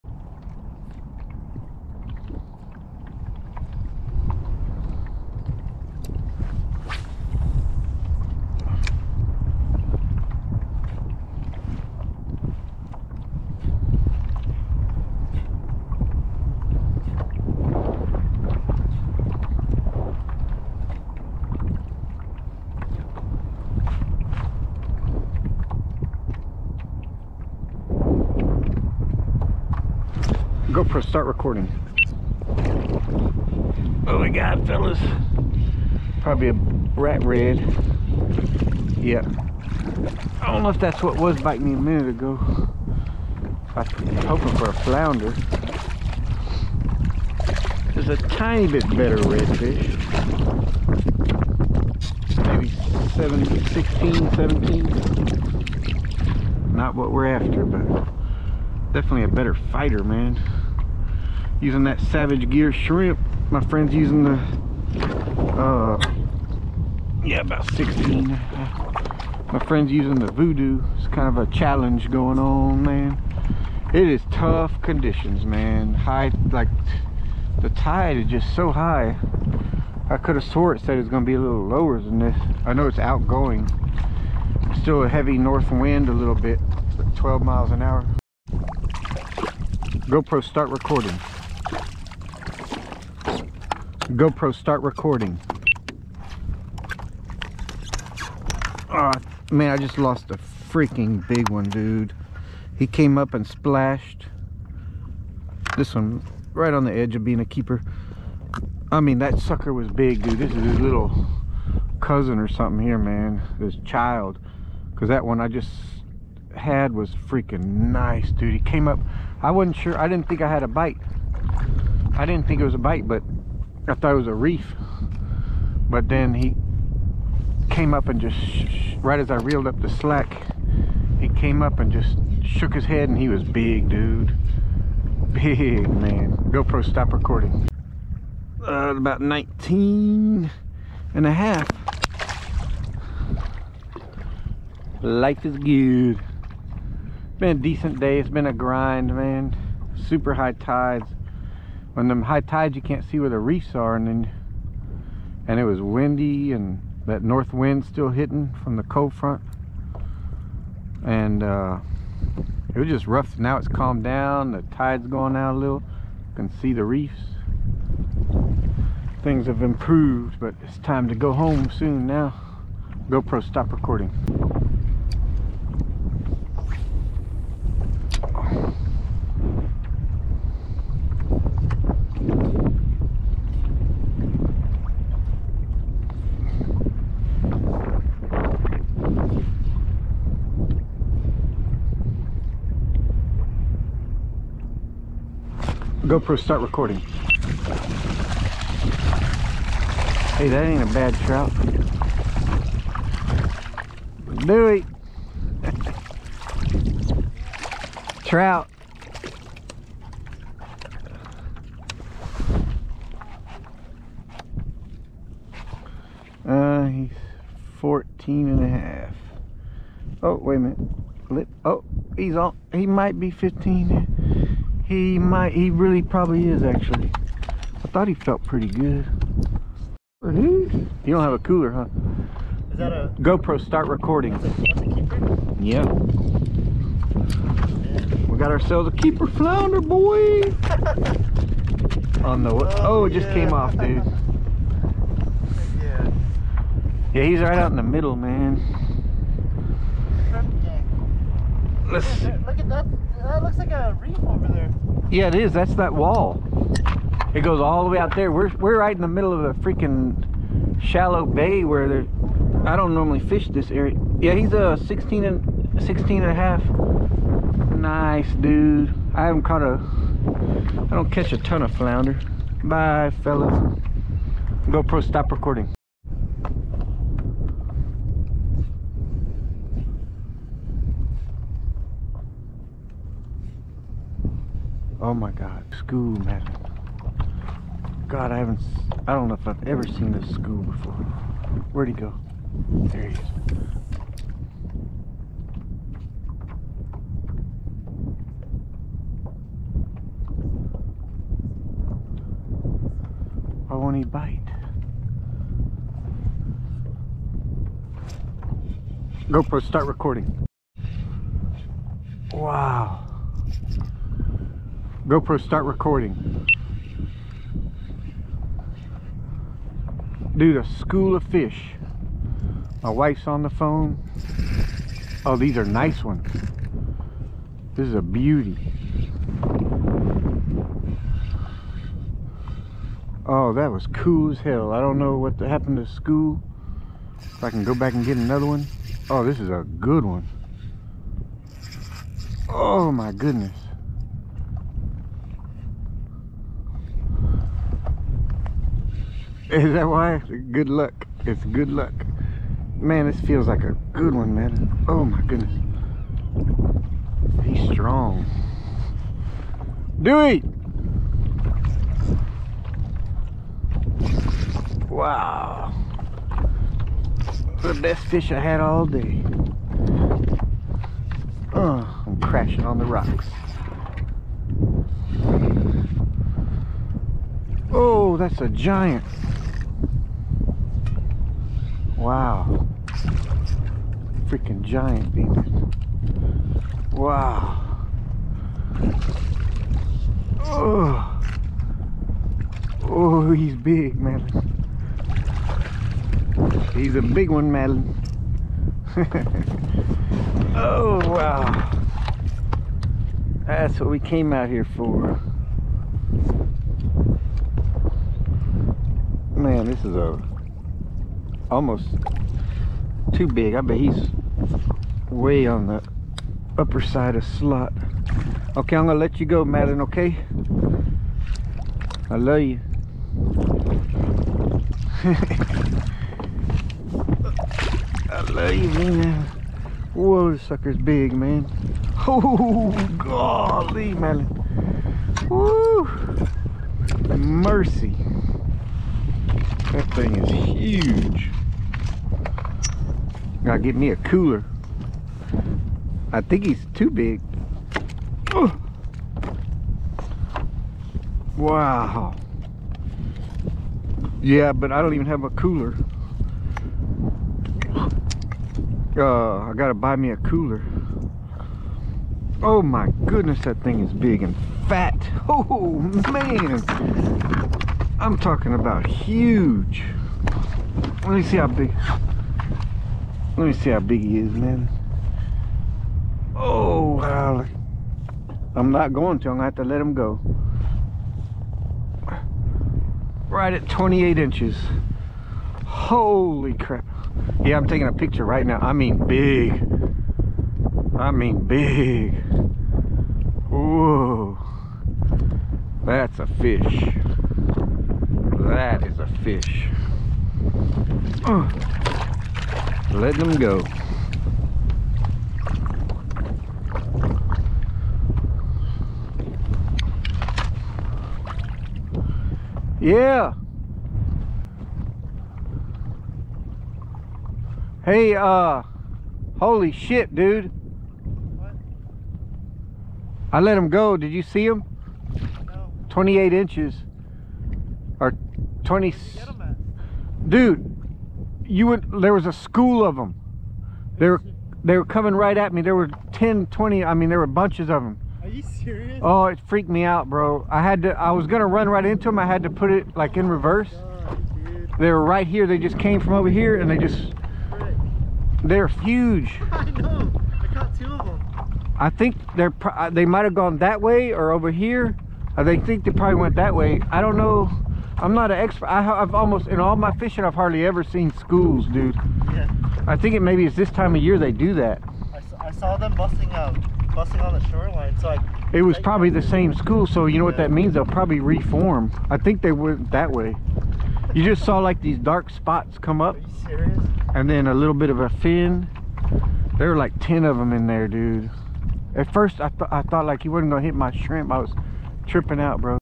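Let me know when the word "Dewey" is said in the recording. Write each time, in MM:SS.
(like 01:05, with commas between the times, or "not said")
03:24, 06:00.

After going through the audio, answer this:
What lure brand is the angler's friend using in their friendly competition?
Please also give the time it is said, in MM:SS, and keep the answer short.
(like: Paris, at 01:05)
Voodoo, at 01:10.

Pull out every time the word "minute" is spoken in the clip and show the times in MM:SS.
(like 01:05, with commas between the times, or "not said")
00:41, 03:40.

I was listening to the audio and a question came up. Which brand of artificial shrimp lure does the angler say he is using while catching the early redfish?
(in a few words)
Savage Gear.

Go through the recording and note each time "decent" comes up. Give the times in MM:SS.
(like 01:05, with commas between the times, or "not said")
02:27.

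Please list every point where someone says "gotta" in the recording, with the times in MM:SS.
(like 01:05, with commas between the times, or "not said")
07:23, 07:39.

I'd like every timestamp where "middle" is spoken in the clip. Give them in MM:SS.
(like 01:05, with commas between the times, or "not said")
04:07, 04:19.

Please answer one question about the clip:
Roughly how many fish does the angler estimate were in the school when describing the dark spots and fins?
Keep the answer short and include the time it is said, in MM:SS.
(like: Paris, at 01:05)
10, at 09:39.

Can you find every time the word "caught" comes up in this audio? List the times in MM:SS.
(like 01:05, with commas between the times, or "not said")
04:29, 09:10.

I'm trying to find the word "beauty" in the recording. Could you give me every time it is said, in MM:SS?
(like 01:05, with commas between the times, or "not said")
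05:28.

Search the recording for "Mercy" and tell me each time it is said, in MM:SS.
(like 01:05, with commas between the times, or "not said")
07:17.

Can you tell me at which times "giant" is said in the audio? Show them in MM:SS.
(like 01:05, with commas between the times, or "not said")
06:18, 06:24.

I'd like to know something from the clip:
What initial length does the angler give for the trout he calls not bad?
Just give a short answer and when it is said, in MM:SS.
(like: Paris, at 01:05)
14 and a half, at 03:37.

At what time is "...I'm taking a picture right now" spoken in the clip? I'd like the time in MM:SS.
08:07.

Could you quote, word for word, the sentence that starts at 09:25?
I, I saw them busting out, um, busting on the shoreline, so I...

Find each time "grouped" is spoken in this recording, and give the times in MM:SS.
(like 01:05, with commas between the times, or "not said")
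not said.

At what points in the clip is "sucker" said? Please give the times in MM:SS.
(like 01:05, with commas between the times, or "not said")
01:49, 07:10.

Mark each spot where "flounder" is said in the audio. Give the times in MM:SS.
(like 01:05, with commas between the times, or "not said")
00:44, 03:59, 04:31.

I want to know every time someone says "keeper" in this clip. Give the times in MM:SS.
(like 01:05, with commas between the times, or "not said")
01:47, 03:58.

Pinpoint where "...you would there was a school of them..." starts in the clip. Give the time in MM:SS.
08:51.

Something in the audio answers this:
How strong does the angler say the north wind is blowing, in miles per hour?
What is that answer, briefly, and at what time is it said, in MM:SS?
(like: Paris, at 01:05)
12, at 01:27.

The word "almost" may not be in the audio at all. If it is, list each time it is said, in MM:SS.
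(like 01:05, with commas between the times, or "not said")
06:51, 09:19.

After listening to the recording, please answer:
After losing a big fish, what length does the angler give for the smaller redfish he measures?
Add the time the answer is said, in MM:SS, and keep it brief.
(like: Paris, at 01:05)
19 and a half, at 02:18.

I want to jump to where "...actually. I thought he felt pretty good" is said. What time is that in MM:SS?
03:46.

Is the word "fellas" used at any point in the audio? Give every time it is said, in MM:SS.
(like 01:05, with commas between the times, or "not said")
00:34, 04:33.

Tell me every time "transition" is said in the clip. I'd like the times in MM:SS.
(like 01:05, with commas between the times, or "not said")
not said.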